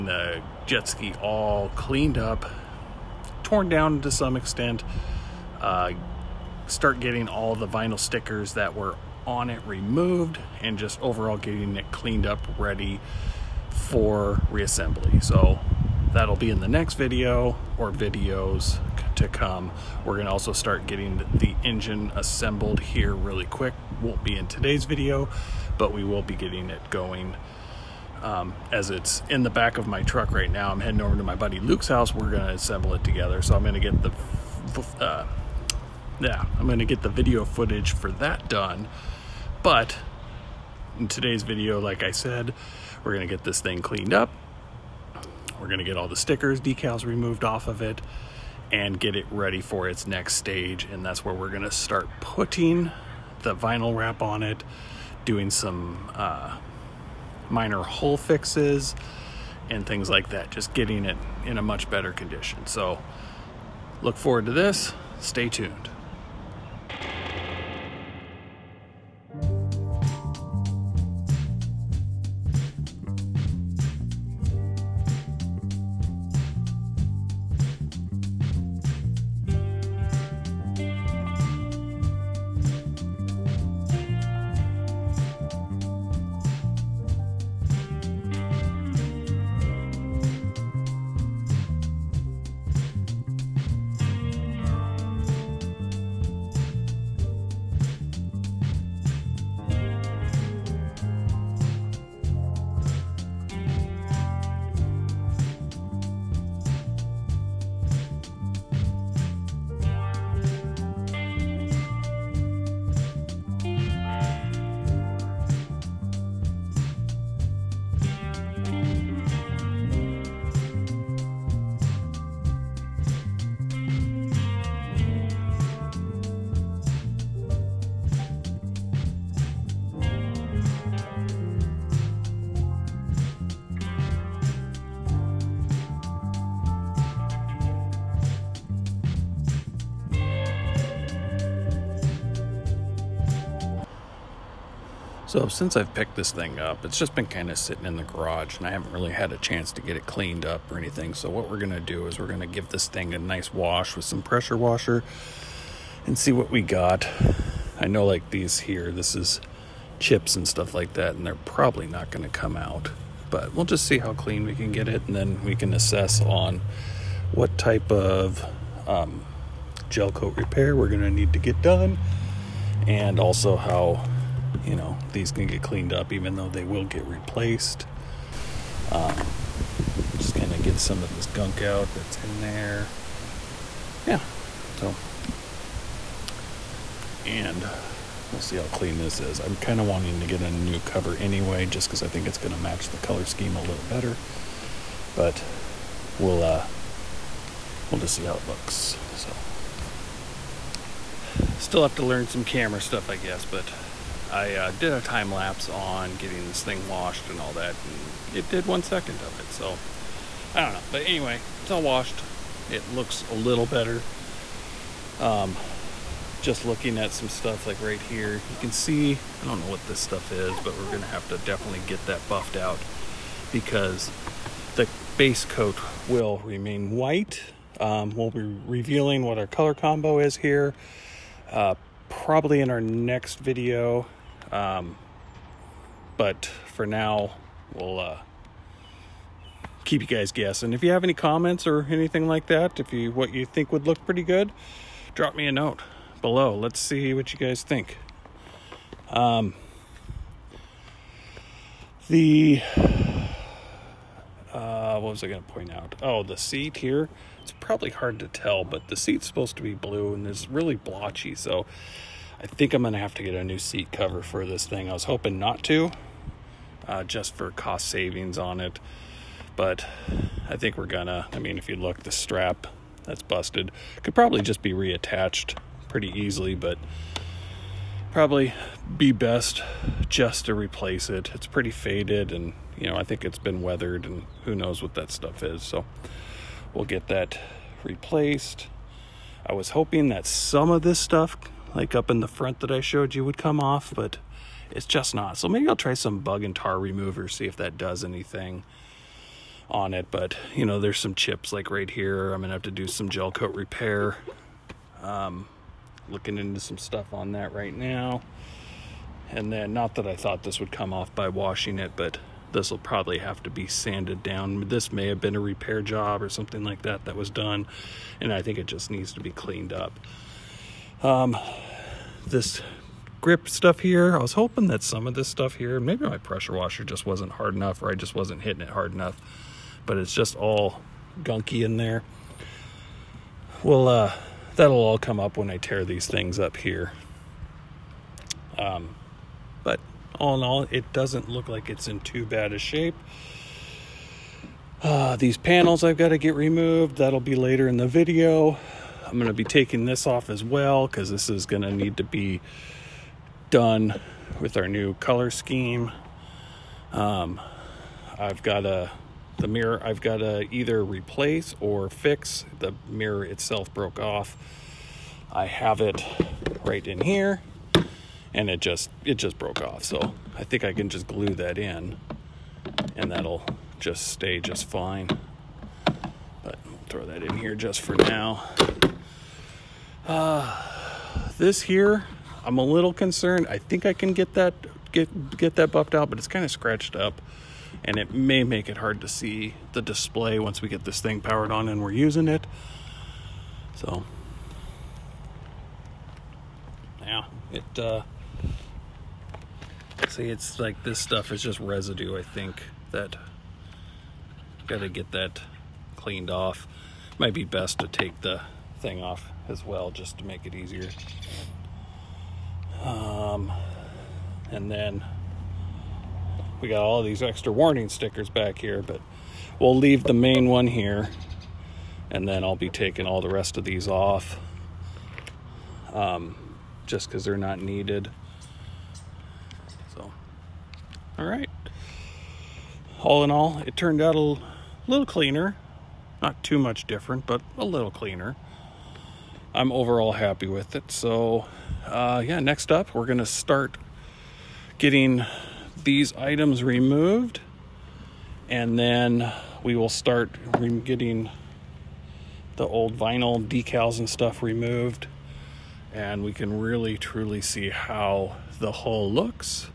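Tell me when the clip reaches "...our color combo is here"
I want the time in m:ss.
3:49.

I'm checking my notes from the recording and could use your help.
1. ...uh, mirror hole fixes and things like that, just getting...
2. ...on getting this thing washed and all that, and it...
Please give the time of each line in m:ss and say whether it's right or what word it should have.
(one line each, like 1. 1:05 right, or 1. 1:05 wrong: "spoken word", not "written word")
1. 0:56 wrong: "minor", not "mirror"
2. 3:25 right.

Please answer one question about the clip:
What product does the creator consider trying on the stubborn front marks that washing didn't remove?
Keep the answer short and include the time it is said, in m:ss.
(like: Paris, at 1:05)
bug and tar remover, at 4:56.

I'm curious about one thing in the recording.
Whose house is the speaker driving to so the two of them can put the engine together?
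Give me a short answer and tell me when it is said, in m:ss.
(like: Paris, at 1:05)
Luke's, at 0:31.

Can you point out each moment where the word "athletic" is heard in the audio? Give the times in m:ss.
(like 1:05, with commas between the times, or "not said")
not said.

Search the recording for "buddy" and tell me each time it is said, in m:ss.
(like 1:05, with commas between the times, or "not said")
0:31.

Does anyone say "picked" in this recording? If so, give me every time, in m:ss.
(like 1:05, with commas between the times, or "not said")
2:25.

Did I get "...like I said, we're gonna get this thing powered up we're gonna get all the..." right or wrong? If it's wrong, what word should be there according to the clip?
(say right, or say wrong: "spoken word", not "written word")
wrong: "cleaned", not "powered".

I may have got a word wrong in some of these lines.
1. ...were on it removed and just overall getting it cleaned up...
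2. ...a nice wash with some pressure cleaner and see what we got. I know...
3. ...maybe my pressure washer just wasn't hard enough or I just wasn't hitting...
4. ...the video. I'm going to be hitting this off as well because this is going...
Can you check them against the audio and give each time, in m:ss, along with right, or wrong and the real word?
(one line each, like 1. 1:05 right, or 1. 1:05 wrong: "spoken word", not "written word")
1. 0:08 right
2. 2:33 wrong: "washer", not "cleaner"
3. 5:25 right
4. 5:47 wrong: "taking", not "hitting".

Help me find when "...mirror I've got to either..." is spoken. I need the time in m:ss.
5:59.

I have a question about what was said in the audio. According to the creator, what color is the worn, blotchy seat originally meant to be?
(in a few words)
blue.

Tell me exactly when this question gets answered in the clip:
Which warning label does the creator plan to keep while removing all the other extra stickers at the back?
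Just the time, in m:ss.
7:00.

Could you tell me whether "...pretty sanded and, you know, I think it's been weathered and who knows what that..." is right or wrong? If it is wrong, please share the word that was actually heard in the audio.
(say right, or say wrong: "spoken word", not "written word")
wrong: "faded", not "sanded".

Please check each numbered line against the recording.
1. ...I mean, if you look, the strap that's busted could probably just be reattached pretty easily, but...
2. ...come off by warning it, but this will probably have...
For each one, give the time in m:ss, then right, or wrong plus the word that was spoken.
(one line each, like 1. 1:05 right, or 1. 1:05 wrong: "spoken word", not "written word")
1. 4:31 right
2. 5:10 wrong: "washing", not "warning".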